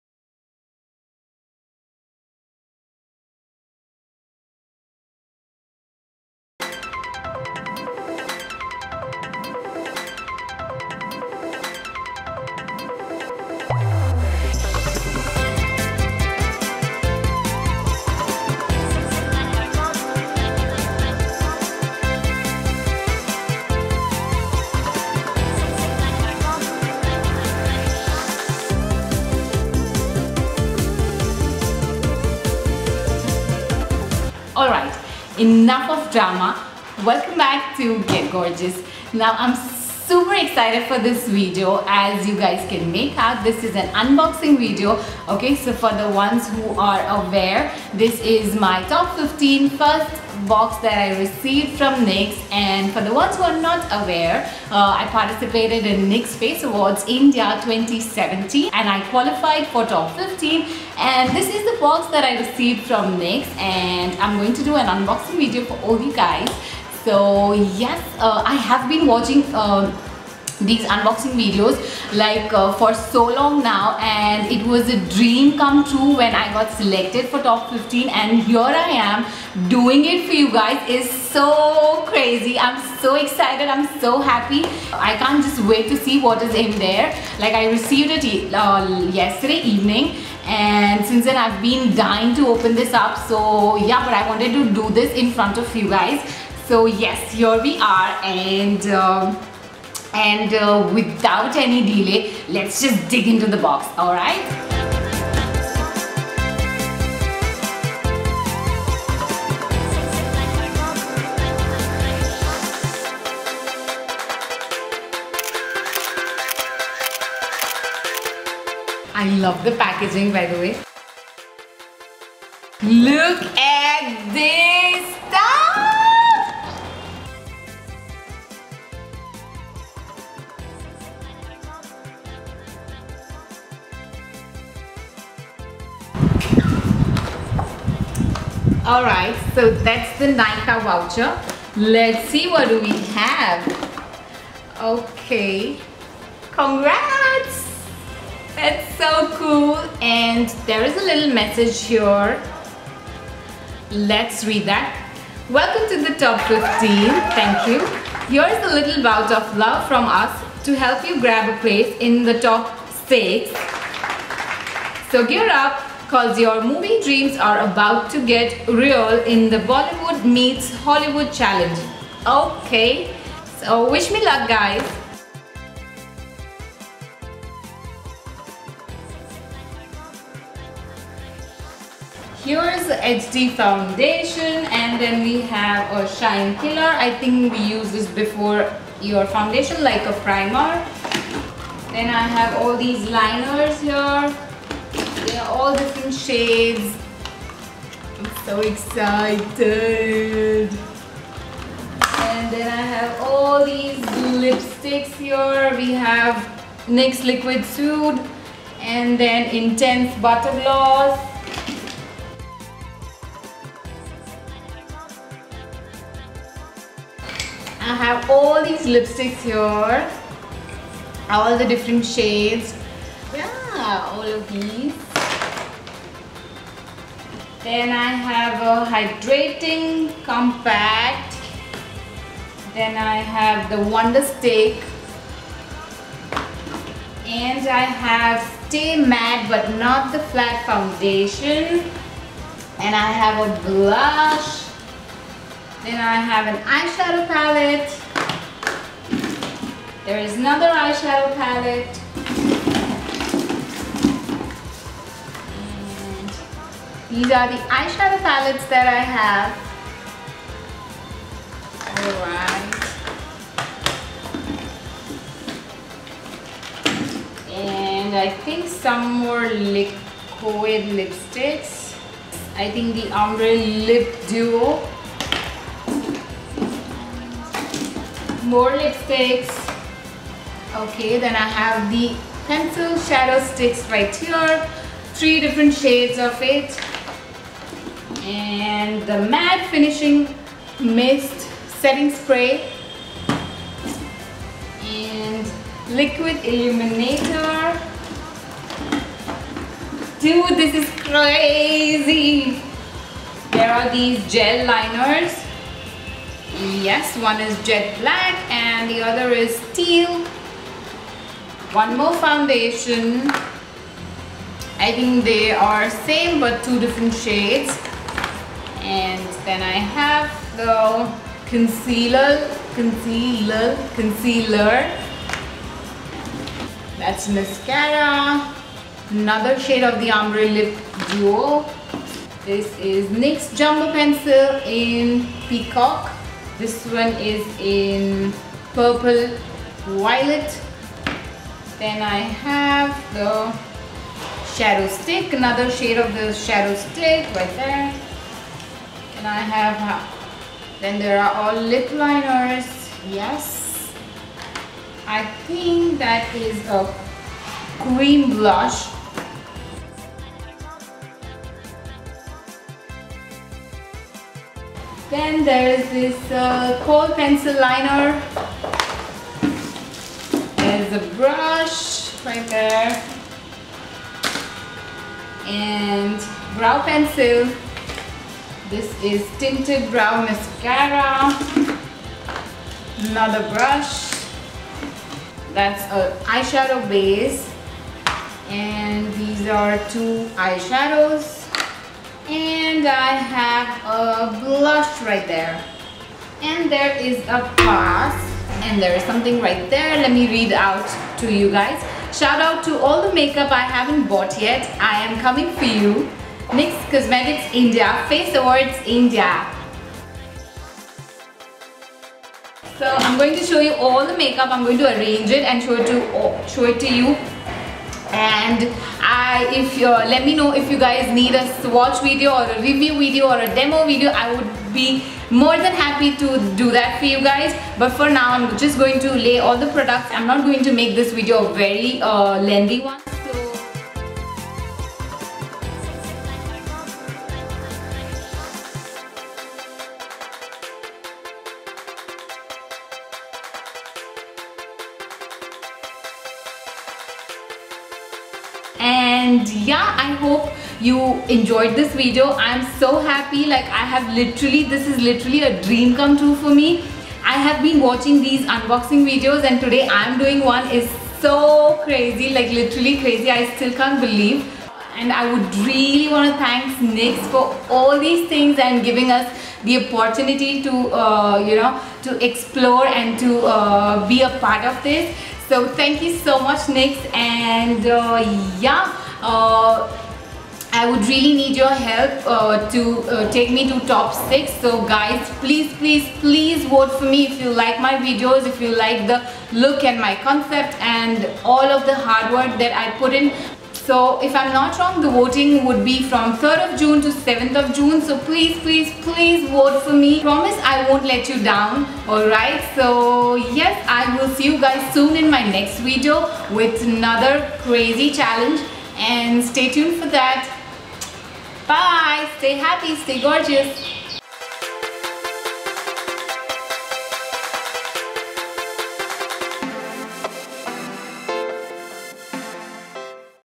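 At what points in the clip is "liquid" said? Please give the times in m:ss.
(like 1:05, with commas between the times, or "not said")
3:27, 4:29, 4:55.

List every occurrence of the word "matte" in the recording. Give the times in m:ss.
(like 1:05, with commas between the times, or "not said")
3:58, 4:49.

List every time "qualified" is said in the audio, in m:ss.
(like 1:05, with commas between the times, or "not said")
0:59.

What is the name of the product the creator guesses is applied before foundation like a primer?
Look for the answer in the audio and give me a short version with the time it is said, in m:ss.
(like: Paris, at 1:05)
Shine killer, at 3:06.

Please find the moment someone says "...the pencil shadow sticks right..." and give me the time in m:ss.
4:41.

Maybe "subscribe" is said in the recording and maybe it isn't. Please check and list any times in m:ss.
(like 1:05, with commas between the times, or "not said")
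not said.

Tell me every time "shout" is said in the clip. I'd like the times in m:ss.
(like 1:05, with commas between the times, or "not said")
6:42.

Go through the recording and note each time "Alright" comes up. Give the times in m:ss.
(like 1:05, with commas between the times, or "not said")
0:34, 2:18, 4:21, 8:22.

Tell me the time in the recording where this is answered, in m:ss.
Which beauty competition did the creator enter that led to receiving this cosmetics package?
0:56.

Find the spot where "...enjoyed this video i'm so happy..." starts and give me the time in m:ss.
7:31.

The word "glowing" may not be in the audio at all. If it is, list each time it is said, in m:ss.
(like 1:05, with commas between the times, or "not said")
not said.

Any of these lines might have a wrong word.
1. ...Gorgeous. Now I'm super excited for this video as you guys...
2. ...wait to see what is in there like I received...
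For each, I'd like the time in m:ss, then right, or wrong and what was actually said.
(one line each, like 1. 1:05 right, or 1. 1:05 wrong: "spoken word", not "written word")
1. 0:38 right
2. 1:25 right.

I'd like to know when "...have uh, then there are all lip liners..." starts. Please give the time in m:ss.
5:49.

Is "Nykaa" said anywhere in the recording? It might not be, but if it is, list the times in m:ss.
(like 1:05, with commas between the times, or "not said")
2:20.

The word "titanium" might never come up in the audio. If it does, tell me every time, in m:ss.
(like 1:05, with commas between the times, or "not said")
not said.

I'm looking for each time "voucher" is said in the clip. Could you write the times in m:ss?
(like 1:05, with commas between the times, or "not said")
2:20.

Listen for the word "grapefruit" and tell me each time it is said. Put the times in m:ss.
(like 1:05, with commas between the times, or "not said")
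not said.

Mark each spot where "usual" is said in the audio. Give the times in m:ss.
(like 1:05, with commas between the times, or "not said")
not said.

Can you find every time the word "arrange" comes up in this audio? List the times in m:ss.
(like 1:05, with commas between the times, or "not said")
6:54.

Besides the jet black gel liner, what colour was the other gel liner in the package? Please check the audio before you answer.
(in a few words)
Teal.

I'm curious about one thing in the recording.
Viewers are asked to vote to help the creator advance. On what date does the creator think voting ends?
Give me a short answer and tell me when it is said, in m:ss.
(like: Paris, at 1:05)
7 June, at 8:17.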